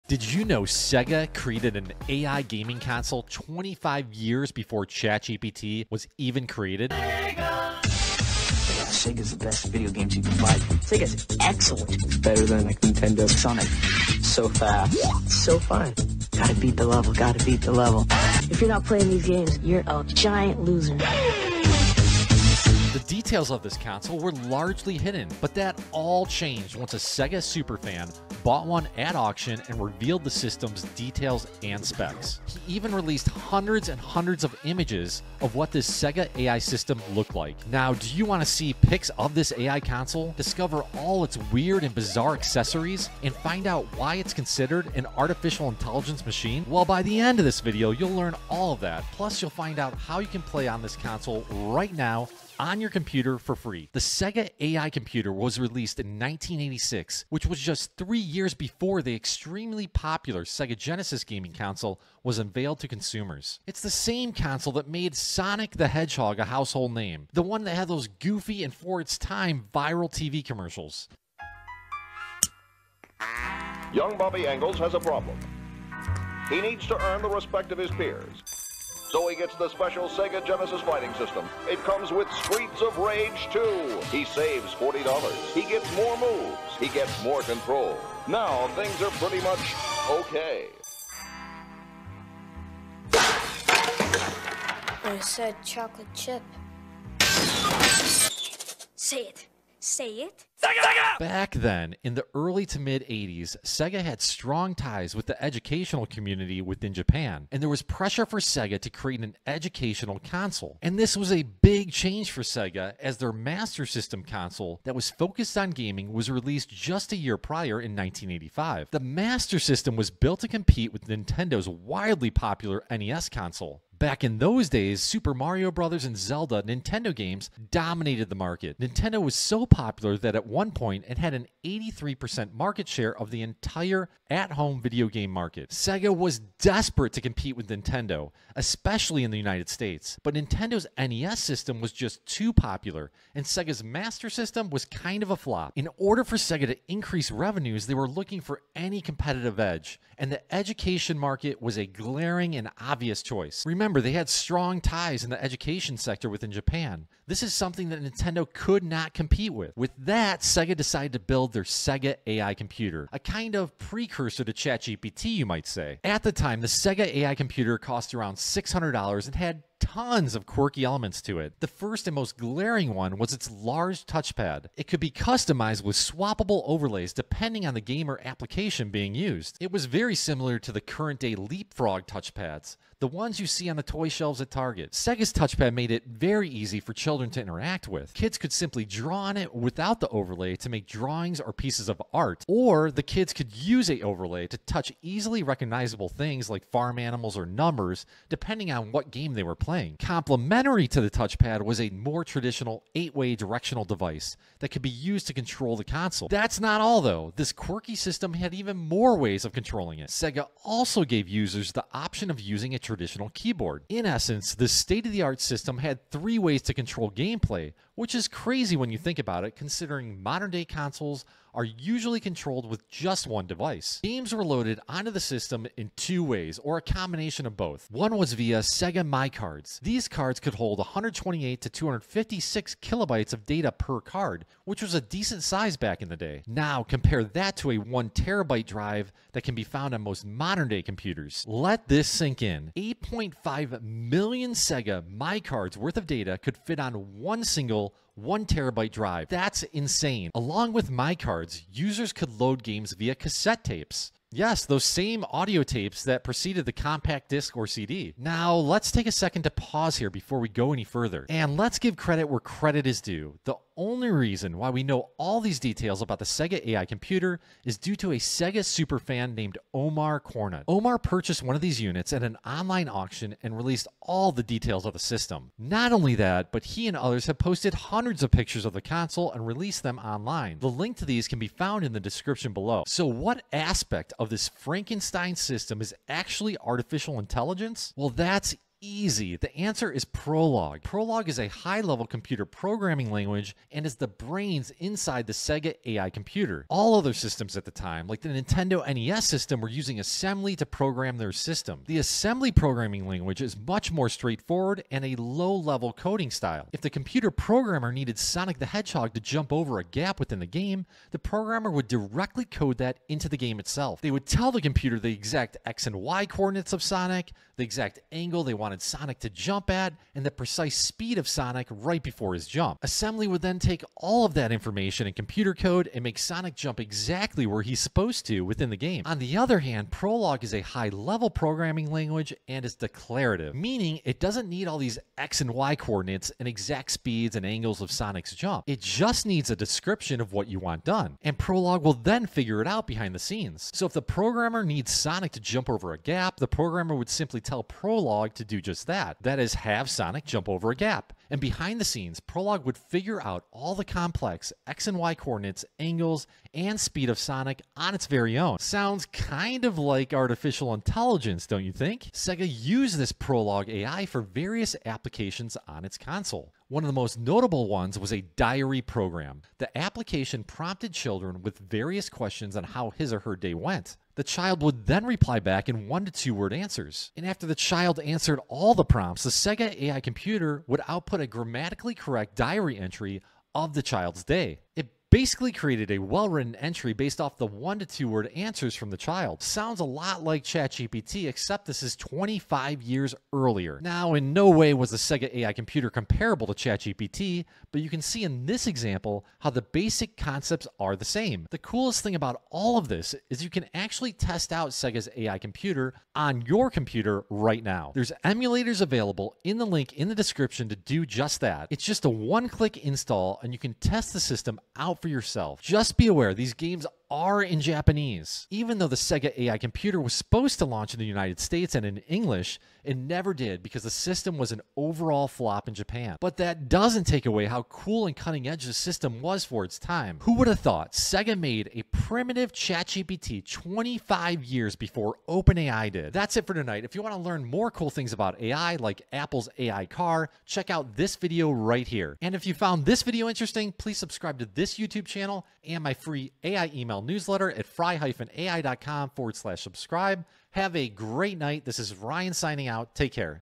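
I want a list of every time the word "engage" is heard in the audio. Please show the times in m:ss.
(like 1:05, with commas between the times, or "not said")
not said.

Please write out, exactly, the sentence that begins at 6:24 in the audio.
It basically created a well-written entry based off the one to two word answers from the child.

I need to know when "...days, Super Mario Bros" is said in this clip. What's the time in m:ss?
2:04.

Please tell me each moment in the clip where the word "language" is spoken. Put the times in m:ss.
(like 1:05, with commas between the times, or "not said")
4:53, 5:03, 5:31.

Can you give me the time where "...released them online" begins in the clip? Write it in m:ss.
4:39.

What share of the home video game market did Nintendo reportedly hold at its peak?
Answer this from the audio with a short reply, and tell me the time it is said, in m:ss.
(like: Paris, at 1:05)
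83%, at 2:11.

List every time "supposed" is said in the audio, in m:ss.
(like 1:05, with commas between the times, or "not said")
5:27, 7:00.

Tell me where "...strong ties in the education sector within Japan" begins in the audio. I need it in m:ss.
2:34.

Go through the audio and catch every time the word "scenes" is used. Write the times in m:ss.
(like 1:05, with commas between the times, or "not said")
5:43, 5:51.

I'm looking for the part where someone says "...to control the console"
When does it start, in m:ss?
3:25.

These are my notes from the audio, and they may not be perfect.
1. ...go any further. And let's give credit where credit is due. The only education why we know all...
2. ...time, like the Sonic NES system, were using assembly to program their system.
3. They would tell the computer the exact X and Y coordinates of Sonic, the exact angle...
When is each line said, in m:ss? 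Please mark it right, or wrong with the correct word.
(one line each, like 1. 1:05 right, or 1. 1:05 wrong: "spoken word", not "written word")
1. 4:20 wrong: "reason", not "education"
2. 4:57 wrong: "Nintendo", not "Sonic"
3. 5:14 right.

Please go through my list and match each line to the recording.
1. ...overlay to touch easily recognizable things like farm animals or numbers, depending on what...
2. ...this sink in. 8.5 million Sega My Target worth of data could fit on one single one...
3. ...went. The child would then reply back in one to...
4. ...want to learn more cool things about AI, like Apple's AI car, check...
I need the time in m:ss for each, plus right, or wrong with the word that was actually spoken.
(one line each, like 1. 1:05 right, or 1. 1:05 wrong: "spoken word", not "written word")
1. 3:14 right
2. 4:01 wrong: "Cards", not "Target"
3. 6:13 right
4. 7:17 right.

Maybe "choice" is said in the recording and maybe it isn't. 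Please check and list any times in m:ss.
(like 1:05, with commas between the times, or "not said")
2:33.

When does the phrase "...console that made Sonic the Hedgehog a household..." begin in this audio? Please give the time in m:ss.
1:04.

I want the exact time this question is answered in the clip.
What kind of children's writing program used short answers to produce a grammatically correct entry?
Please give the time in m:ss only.
6:08.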